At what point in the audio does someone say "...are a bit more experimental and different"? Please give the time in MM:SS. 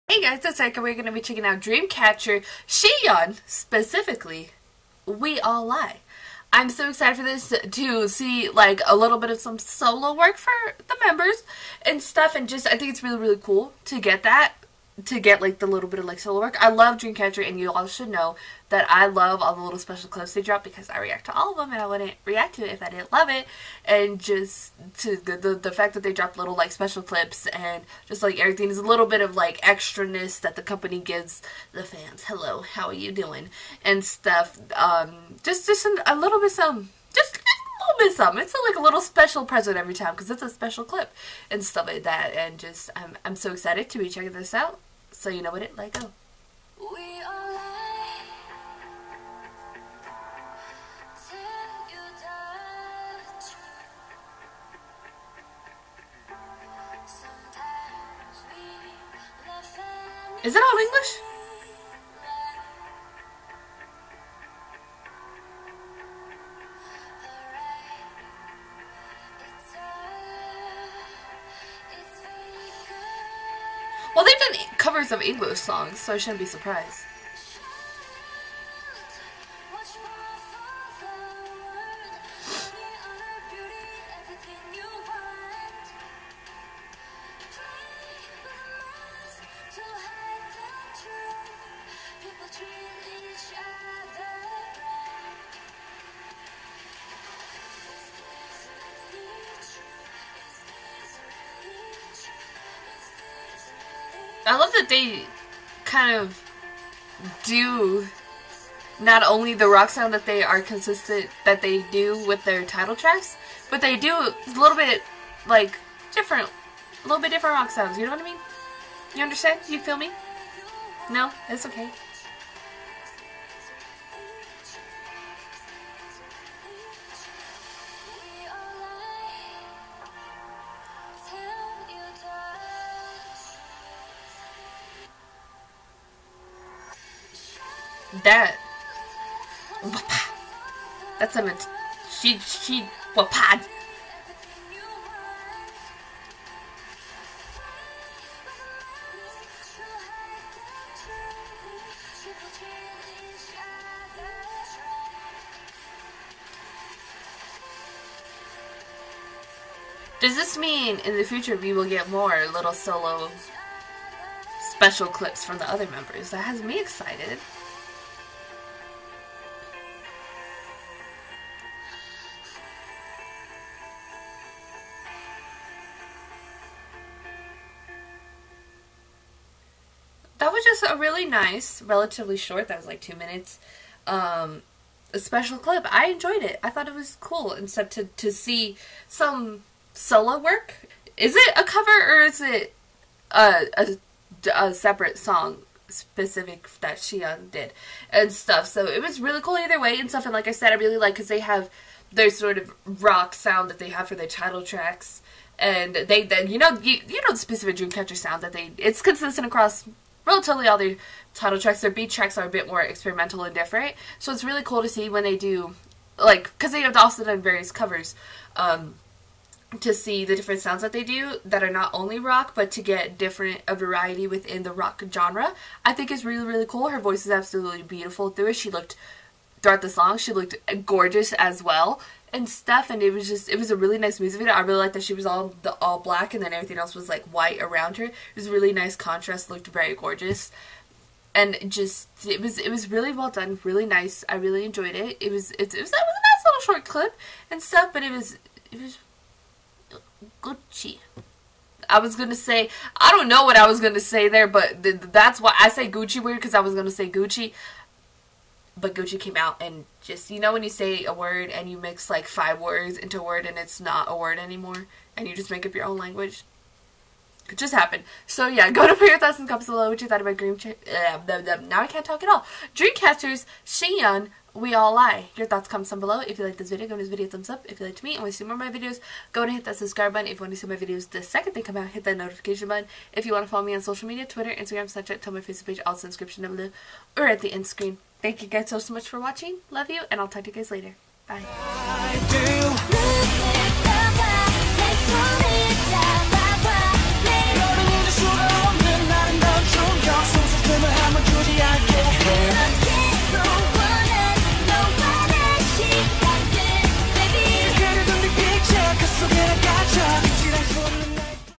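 03:32.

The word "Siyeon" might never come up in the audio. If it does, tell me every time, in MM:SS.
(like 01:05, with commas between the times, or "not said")
00:02, 03:16, 04:33.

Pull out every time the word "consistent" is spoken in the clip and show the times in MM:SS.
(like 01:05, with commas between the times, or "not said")
01:50, 03:29.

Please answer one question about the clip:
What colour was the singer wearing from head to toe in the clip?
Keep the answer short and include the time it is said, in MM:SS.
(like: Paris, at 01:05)
All black, at 03:55.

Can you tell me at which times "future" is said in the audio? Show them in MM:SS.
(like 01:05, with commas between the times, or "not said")
02:41.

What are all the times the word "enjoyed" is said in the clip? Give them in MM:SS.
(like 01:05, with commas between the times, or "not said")
03:06, 04:04.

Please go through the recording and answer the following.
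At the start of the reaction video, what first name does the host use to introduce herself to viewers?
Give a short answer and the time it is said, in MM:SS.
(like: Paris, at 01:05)
Erika, at 00:00.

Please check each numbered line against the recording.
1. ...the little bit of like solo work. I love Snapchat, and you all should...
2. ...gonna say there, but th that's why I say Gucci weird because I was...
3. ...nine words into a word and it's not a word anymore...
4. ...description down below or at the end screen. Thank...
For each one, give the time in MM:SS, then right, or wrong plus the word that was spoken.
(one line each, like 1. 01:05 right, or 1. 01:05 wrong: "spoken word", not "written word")
1. 00:15 wrong: "Dreamcatcher", not "Snapchat"
2. 04:13 right
3. 04:22 wrong: "five", not "nine"
4. 04:46 right.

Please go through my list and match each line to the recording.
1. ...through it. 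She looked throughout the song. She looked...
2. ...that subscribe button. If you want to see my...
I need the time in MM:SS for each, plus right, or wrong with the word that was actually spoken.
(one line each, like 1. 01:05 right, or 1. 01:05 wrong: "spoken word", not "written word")
1. 03:48 right
2. 04:39 right.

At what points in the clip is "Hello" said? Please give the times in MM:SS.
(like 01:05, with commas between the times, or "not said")
00:32.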